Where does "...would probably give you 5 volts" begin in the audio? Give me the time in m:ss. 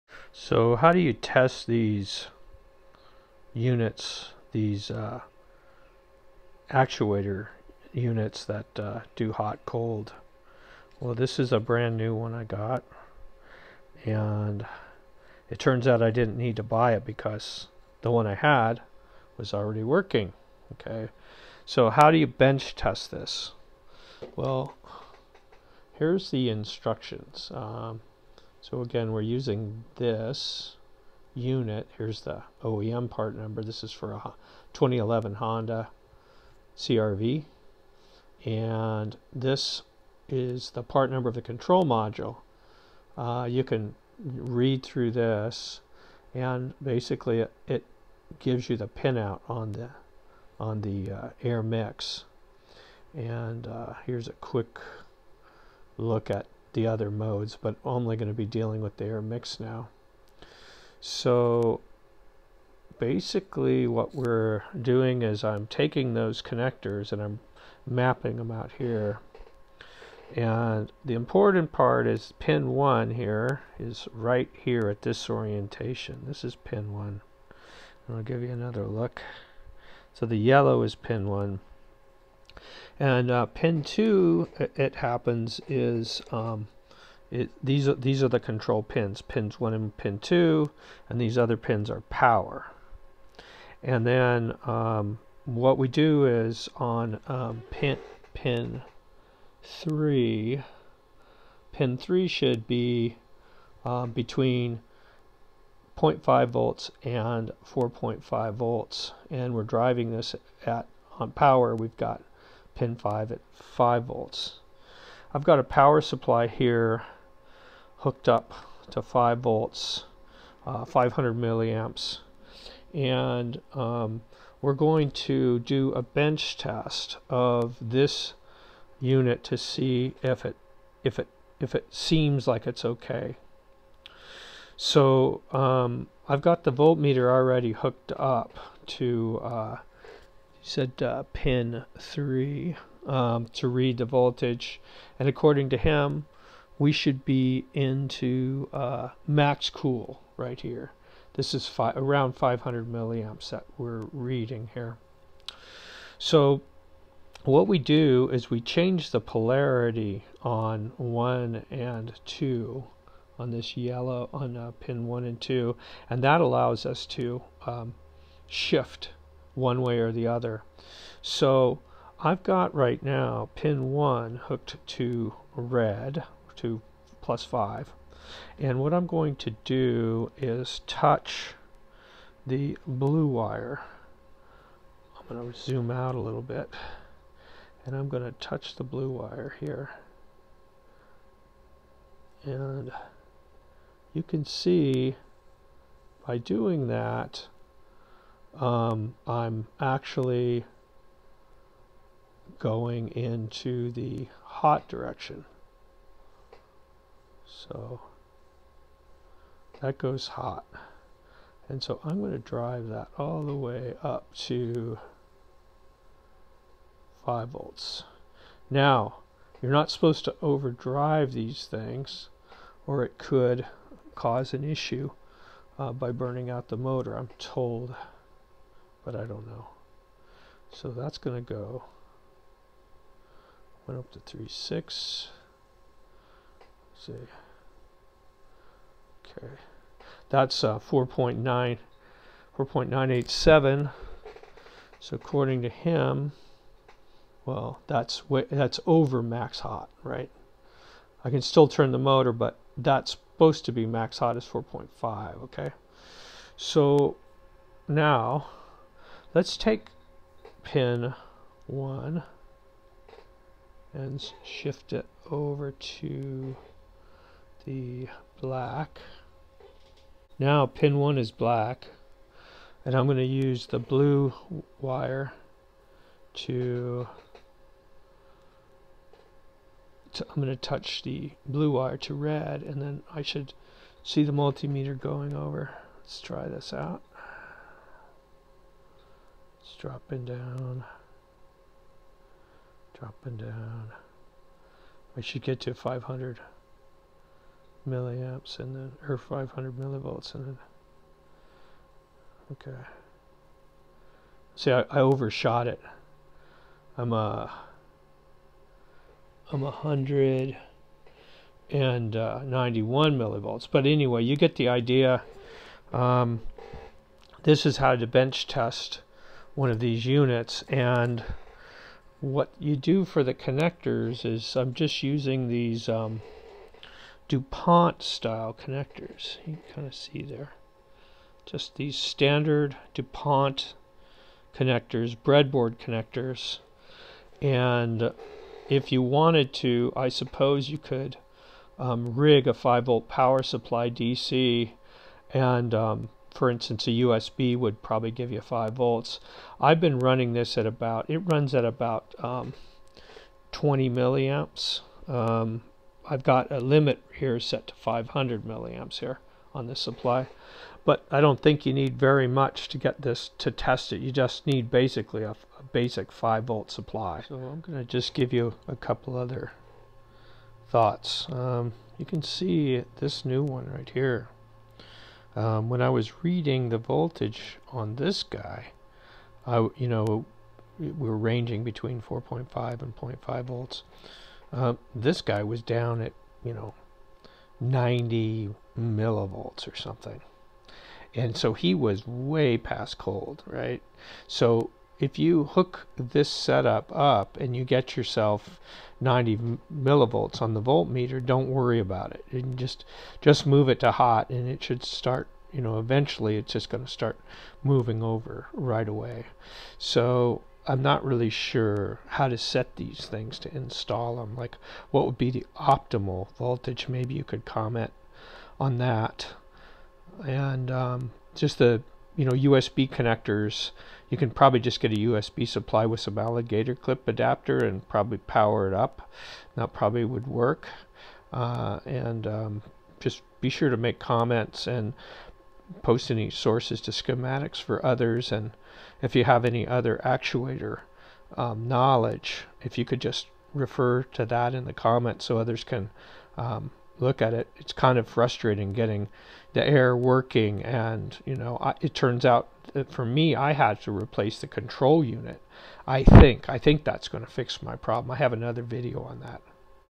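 5:47.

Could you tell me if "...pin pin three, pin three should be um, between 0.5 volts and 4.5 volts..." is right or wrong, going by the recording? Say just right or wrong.
right.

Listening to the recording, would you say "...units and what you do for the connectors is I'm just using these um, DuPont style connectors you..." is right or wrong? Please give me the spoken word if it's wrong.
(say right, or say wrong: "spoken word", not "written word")
right.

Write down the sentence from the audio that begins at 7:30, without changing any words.
And, you know, I, it turns out that for me, I had to replace the control unit.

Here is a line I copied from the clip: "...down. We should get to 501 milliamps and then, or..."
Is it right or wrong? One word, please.
wrong.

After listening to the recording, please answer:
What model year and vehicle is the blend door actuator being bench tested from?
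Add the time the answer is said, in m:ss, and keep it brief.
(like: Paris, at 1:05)
2011 Honda CRV, at 0:34.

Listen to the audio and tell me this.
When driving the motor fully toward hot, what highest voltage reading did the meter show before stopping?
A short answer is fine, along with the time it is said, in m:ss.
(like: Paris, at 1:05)
4.987, at 4:02.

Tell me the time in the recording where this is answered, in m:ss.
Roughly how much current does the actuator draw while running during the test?
5:53.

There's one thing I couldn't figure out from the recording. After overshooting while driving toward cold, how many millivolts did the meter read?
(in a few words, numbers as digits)
191 millivolts.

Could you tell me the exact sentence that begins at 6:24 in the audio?
Um, this guy was down at you know 90 millivolts or something, and so he was way past cold, right?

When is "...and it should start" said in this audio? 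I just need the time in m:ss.
6:44.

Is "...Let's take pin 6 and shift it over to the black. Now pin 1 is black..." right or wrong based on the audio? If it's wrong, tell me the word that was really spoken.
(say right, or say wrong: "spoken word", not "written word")
wrong: "1", not "6".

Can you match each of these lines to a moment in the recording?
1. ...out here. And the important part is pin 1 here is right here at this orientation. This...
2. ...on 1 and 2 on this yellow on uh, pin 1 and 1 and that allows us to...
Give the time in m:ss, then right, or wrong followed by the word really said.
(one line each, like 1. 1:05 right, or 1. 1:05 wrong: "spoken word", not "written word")
1. 1:08 right
2. 2:40 wrong: "2", not "1".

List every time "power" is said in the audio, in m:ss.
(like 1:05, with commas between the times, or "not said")
1:32, 1:51, 1:55, 5:43, 7:08.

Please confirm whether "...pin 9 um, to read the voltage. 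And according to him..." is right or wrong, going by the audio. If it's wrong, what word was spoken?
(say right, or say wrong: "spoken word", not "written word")
wrong: "3", not "9".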